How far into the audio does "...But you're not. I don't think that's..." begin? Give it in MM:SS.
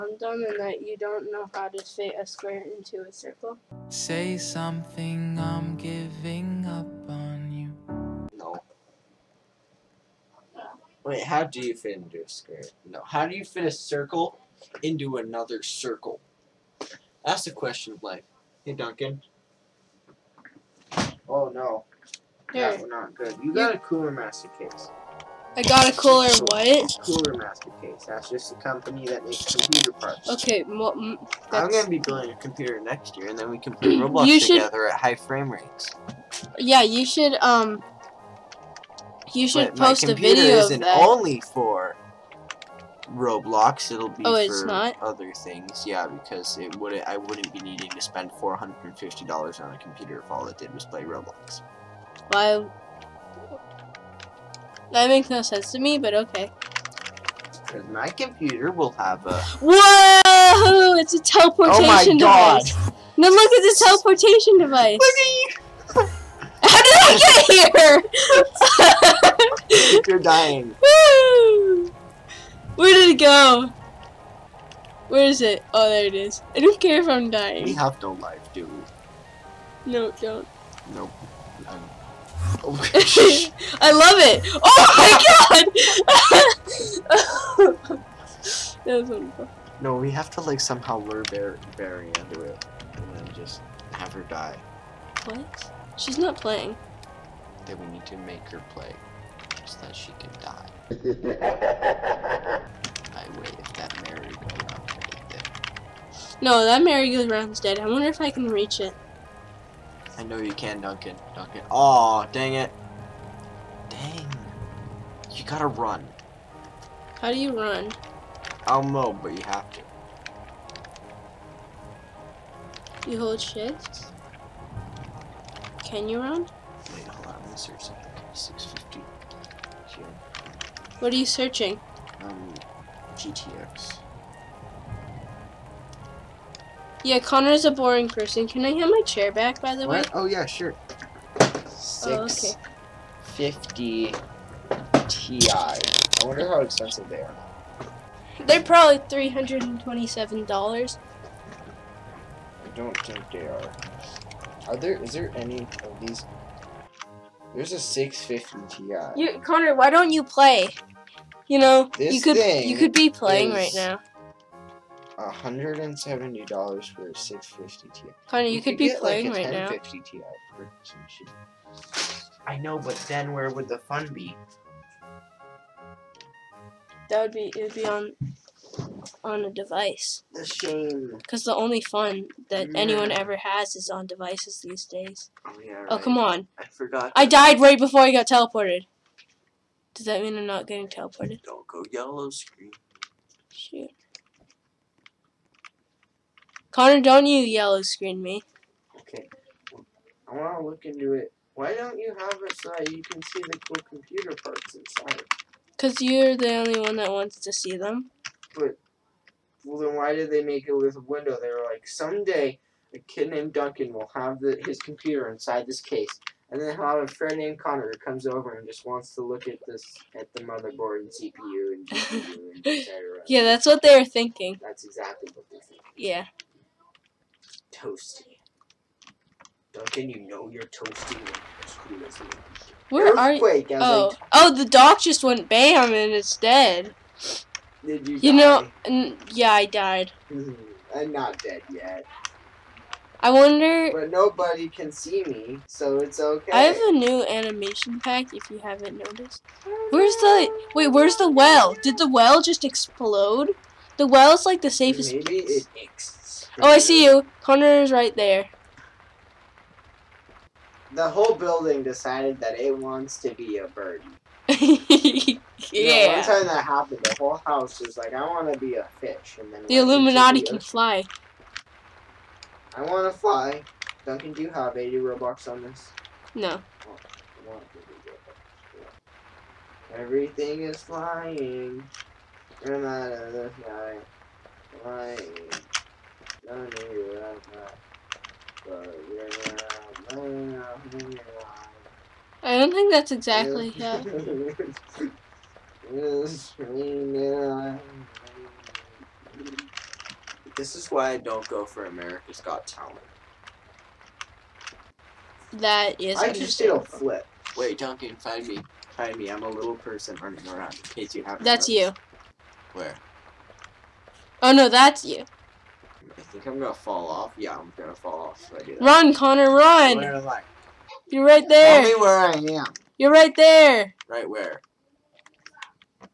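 04:48.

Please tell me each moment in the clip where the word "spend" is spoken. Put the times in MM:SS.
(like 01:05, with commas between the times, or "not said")
00:48.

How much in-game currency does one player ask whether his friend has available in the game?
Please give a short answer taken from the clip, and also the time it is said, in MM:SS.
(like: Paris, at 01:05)
80 Robux, at 04:34.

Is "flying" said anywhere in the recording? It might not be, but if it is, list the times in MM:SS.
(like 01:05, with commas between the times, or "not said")
04:40, 04:44.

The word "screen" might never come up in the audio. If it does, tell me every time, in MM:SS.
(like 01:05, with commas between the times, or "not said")
03:12, 03:17.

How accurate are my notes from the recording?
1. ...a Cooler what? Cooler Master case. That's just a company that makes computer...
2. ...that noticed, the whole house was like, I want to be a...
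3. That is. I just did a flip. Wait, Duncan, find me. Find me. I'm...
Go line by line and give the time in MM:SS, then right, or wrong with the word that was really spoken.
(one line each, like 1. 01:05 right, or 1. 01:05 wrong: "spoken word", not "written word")
1. 00:25 right
2. 04:26 wrong: "happened", not "noticed"
3. 05:05 right.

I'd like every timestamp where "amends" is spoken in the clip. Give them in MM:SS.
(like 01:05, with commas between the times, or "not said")
not said.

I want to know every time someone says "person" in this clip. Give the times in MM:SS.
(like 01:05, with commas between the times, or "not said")
02:18, 05:09.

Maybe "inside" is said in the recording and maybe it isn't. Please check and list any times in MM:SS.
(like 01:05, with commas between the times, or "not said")
03:24, 03:35.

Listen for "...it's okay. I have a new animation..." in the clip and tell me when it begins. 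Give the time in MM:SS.
04:05.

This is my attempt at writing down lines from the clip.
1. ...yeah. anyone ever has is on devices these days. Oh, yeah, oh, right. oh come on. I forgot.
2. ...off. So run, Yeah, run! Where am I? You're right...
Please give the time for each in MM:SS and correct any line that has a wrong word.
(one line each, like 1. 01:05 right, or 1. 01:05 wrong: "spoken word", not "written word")
1. 03:02 right
2. 05:18 wrong: "Connor", not "Yeah".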